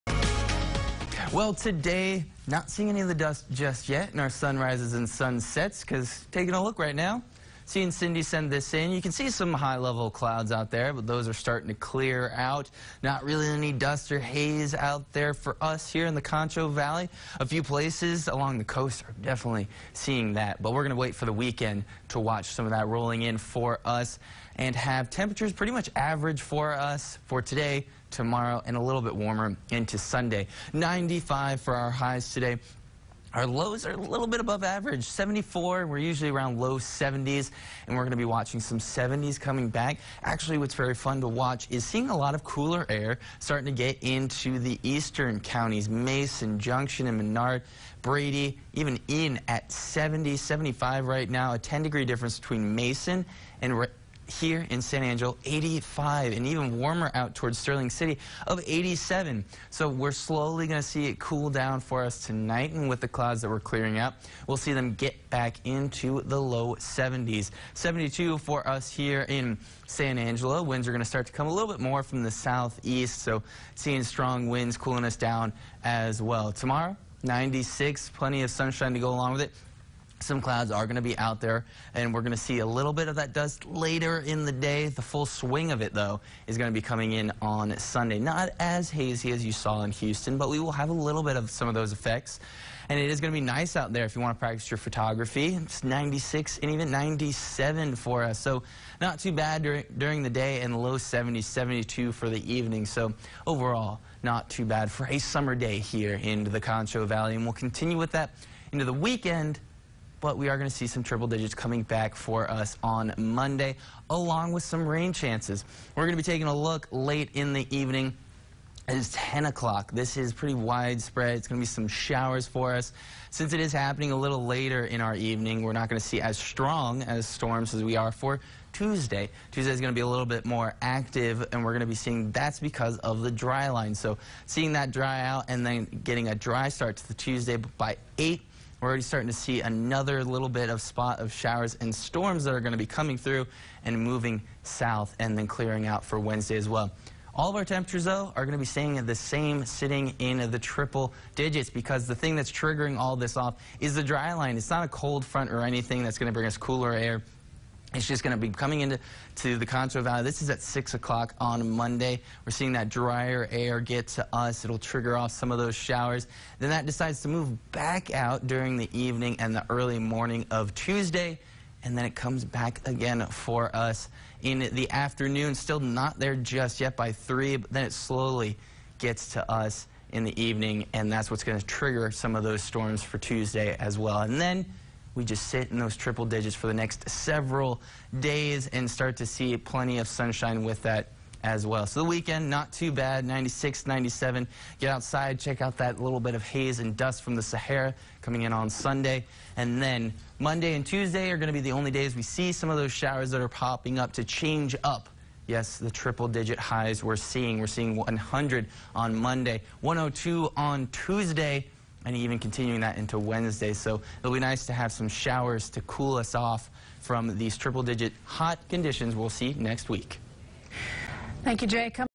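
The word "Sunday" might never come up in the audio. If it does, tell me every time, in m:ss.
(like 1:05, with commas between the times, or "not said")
0:29, 1:27, 3:18.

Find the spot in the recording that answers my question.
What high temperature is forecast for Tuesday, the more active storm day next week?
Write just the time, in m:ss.
3:29.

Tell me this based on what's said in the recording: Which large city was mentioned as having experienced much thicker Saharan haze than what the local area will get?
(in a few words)
Houston.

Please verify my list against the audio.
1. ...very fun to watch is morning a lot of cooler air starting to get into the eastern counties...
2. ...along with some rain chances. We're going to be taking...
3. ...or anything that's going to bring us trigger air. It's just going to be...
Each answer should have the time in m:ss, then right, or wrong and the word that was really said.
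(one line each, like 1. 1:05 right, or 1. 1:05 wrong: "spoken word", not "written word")
1. 0:40 wrong: "seeing", not "morning"
2. 1:54 right
3. 2:35 wrong: "cooler", not "trigger".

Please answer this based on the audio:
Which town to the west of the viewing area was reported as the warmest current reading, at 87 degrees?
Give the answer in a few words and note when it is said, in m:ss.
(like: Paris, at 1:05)
Sterling City, at 0:57.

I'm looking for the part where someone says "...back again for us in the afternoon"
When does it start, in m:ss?
2:52.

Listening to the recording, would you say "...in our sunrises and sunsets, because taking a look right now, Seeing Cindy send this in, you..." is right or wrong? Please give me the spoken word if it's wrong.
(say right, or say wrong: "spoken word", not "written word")
right.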